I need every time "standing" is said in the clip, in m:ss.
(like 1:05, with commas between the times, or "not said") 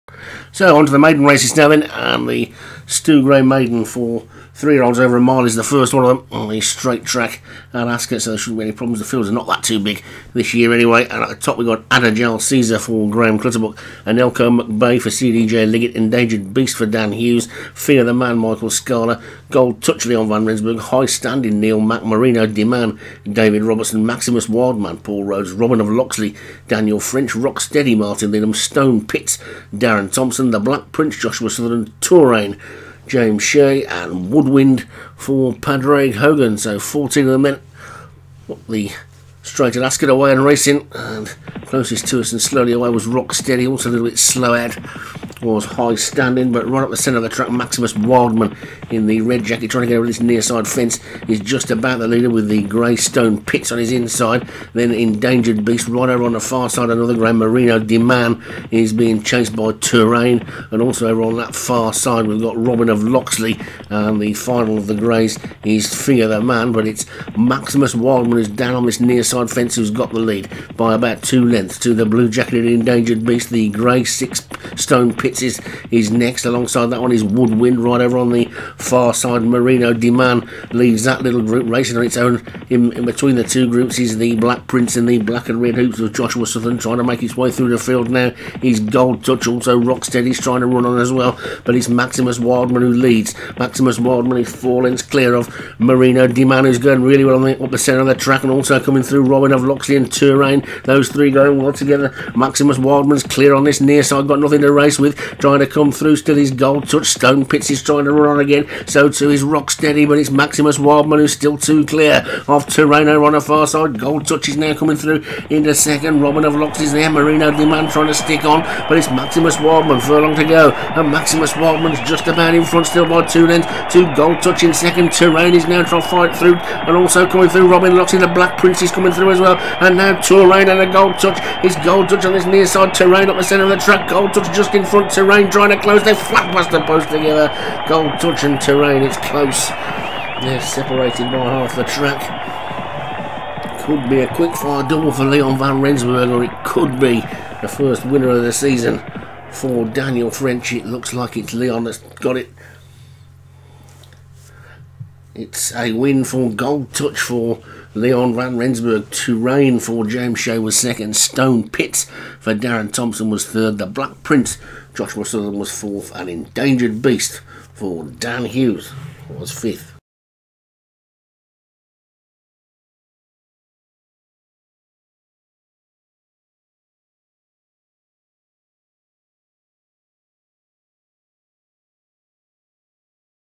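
0:21, 0:45.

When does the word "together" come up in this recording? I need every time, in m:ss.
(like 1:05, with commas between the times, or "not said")
1:41, 2:17.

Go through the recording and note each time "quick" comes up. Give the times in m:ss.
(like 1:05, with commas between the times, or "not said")
2:24.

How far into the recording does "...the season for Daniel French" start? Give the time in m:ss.
2:28.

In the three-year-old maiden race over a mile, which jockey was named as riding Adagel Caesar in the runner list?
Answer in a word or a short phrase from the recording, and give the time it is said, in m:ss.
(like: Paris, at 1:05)
Graham Clutterbuck, at 0:13.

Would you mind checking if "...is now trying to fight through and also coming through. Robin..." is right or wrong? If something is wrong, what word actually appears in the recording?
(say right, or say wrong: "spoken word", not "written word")
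right.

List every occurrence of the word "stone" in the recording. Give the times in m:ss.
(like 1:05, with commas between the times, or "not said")
0:28, 0:52, 1:14, 1:47, 2:41.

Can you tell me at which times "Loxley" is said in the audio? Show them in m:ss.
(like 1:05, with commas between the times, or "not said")
0:25, 1:03, 1:39.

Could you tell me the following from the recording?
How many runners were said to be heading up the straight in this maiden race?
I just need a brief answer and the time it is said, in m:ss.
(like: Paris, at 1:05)
14, at 0:36.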